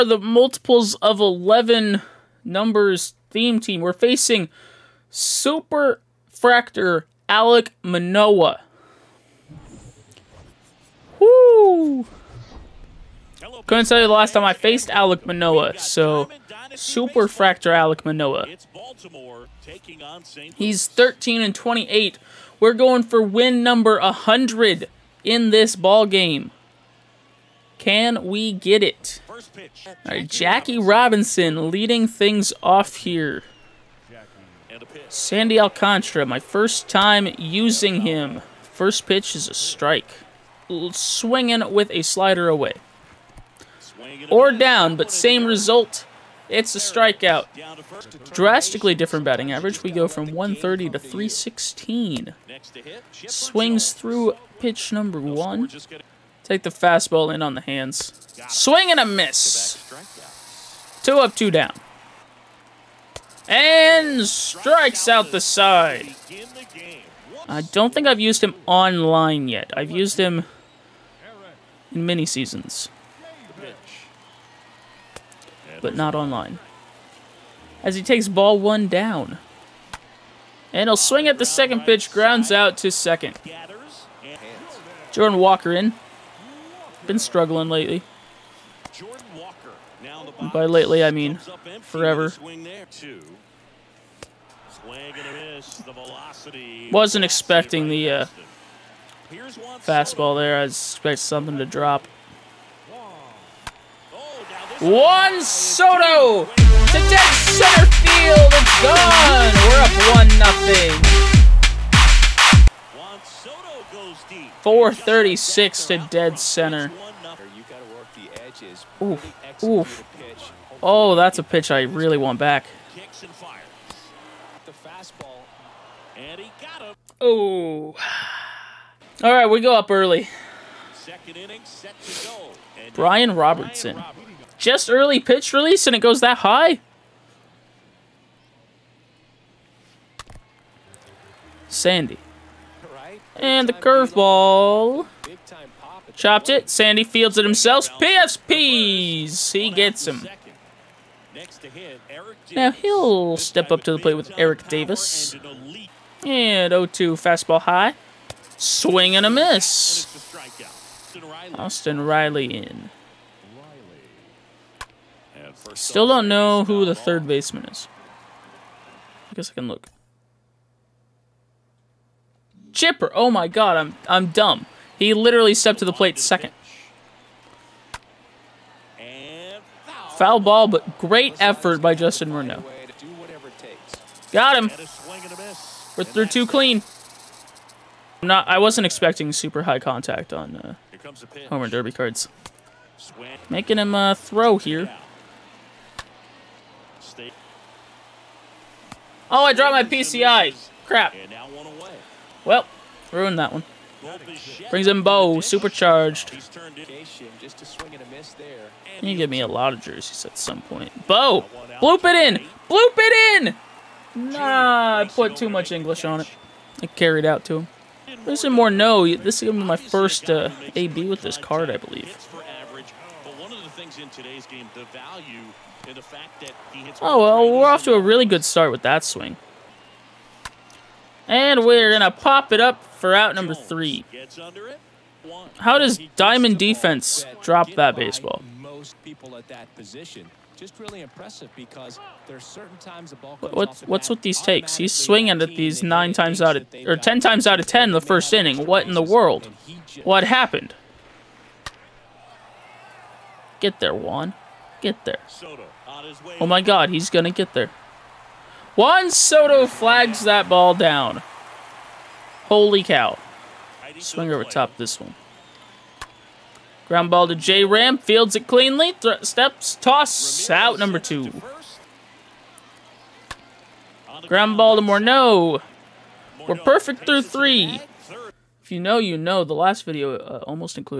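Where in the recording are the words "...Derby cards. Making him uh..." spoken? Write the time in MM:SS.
03:11.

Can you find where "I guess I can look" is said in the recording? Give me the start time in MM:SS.
02:49.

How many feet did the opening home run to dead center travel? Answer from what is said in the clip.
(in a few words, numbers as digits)
436.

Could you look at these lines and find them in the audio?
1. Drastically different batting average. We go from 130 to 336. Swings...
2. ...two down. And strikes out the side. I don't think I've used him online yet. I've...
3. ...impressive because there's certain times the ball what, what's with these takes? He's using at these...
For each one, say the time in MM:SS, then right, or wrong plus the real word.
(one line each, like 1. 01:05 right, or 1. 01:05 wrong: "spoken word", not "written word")
1. 00:48 wrong: "316", not "336"
2. 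01:01 right
3. 04:01 wrong: "swinging", not "using".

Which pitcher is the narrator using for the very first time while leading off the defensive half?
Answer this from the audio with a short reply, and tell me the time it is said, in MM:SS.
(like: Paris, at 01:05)
Sandy Alcantara, at 00:35.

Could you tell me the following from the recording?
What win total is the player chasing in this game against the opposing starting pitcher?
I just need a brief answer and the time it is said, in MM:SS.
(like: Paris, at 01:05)
100, at 00:23.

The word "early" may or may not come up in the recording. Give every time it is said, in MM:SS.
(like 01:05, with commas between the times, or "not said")
02:09, 02:14.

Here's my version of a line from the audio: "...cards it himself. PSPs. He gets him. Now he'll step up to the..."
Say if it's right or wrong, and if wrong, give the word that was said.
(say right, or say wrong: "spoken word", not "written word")
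wrong: "fields", not "cards".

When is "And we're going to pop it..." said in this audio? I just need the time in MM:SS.
03:51.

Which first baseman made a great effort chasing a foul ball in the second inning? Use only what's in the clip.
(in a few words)
Justin Morneau.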